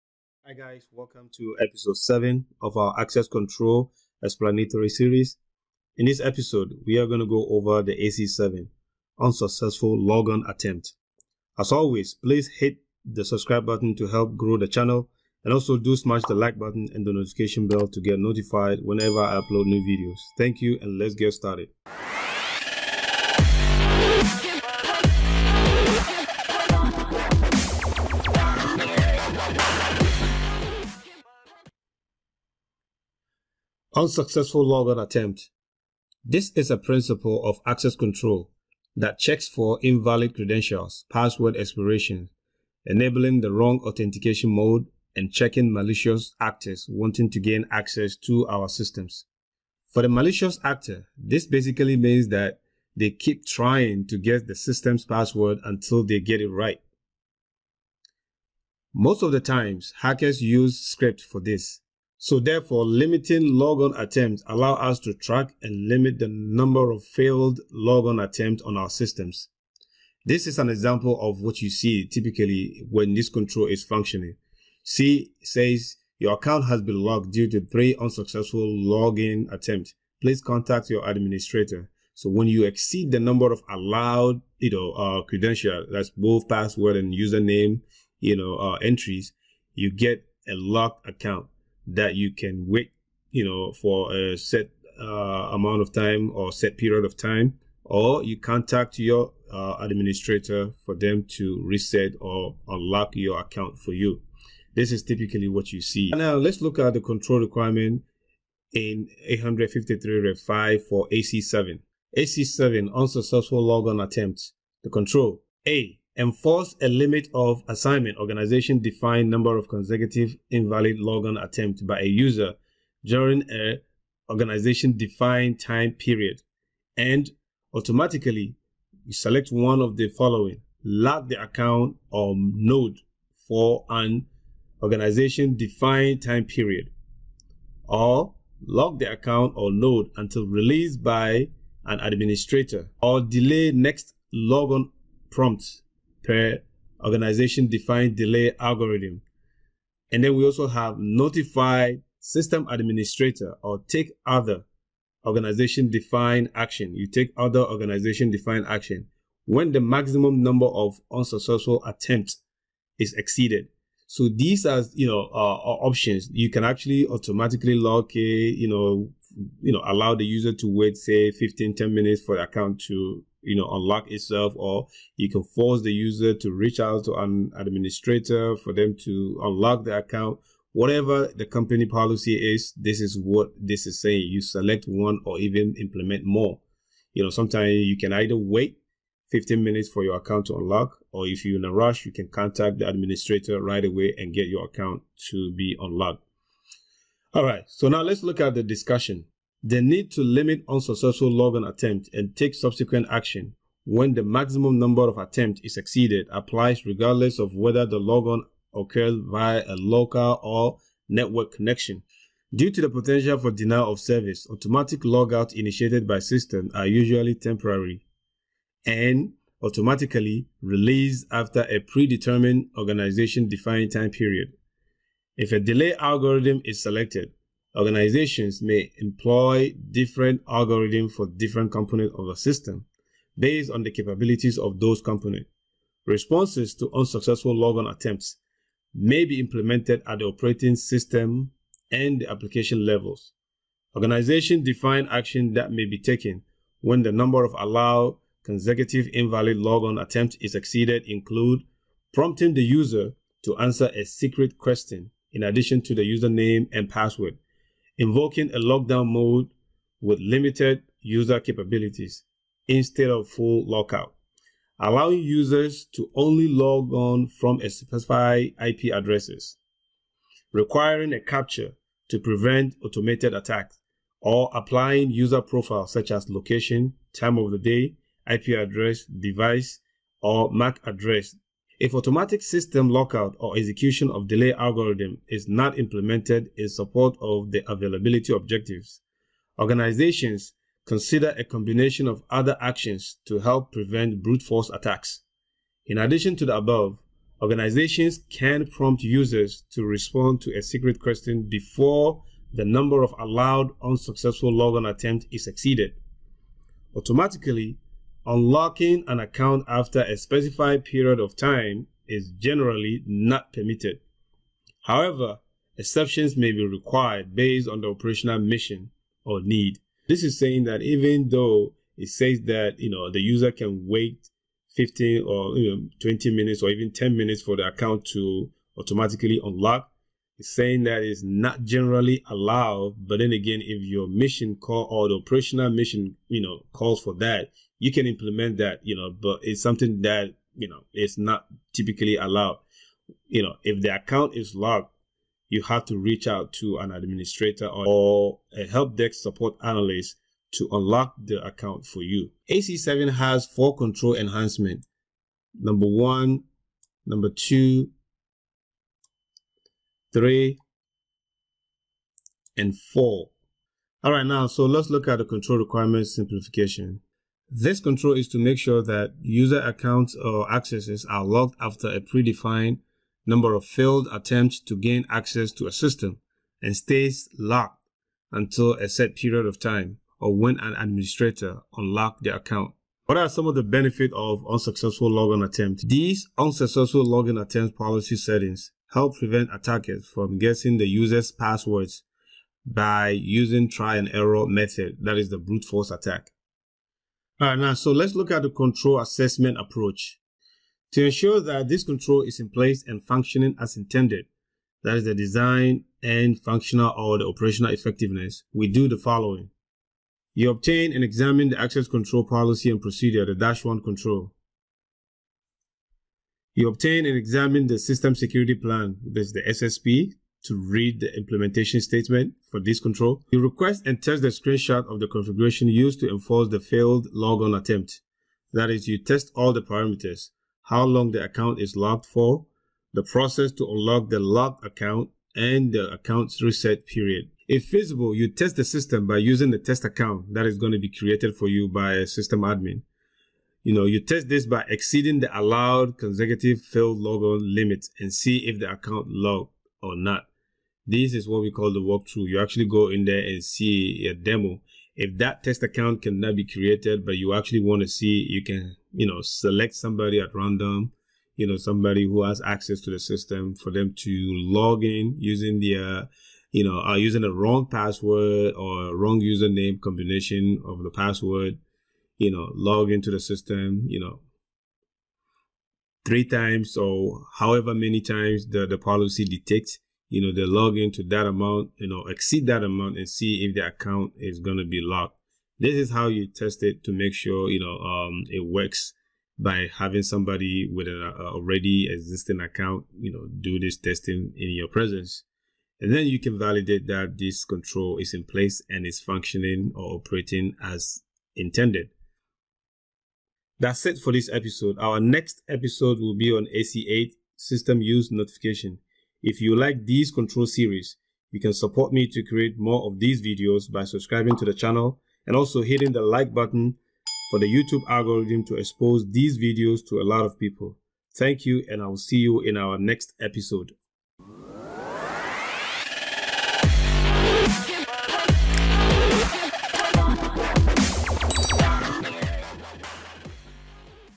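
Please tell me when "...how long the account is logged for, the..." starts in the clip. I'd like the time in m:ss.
7:10.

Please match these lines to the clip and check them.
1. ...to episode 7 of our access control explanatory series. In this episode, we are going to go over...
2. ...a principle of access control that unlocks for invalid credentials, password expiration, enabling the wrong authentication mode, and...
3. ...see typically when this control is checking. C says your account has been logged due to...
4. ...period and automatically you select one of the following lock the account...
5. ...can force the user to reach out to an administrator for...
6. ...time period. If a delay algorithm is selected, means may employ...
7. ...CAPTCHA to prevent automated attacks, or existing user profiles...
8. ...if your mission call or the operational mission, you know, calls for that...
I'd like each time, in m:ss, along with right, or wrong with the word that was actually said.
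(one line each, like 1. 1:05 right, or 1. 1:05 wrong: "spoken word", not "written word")
1. 0:01 right
2. 0:36 wrong: "checks", not "unlocks"
3. 1:11 wrong: "functioning", not "checking"
4. 2:05 right
5. 2:55 right
6. 3:43 wrong: "organizations", not "means"
7. 4:31 wrong: "applying", not "existing"
8. 5:33 right.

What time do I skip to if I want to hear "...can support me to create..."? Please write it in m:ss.
8:31.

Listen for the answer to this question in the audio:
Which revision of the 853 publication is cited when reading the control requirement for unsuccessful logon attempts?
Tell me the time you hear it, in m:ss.
1:50.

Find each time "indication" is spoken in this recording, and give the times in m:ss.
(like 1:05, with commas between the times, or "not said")
not said.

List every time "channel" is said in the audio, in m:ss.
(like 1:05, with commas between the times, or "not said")
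0:14, 8:34.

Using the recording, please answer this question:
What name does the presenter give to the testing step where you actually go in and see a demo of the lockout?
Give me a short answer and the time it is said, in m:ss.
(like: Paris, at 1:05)
walkthrough, at 7:31.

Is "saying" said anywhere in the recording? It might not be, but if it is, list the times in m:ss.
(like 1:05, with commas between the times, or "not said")
3:04, 5:20, 5:30.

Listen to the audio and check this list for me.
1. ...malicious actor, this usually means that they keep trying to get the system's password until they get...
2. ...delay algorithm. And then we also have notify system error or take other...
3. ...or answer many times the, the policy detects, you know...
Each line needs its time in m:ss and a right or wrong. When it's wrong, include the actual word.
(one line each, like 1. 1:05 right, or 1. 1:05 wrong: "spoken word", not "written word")
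1. 0:50 wrong: "basically", not "usually"
2. 2:28 wrong: "administrator", not "error"
3. 7:56 wrong: "however", not "answer".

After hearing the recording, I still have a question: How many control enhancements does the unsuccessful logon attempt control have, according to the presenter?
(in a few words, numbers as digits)
4.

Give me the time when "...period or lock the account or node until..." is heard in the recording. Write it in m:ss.
2:16.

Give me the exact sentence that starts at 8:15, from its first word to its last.
And then you can validate that this control is in place and is functioning or operating as intended.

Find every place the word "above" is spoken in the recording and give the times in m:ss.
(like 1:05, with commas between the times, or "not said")
4:56.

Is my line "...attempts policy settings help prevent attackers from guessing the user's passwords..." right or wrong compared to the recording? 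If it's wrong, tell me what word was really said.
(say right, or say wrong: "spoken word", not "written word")
right.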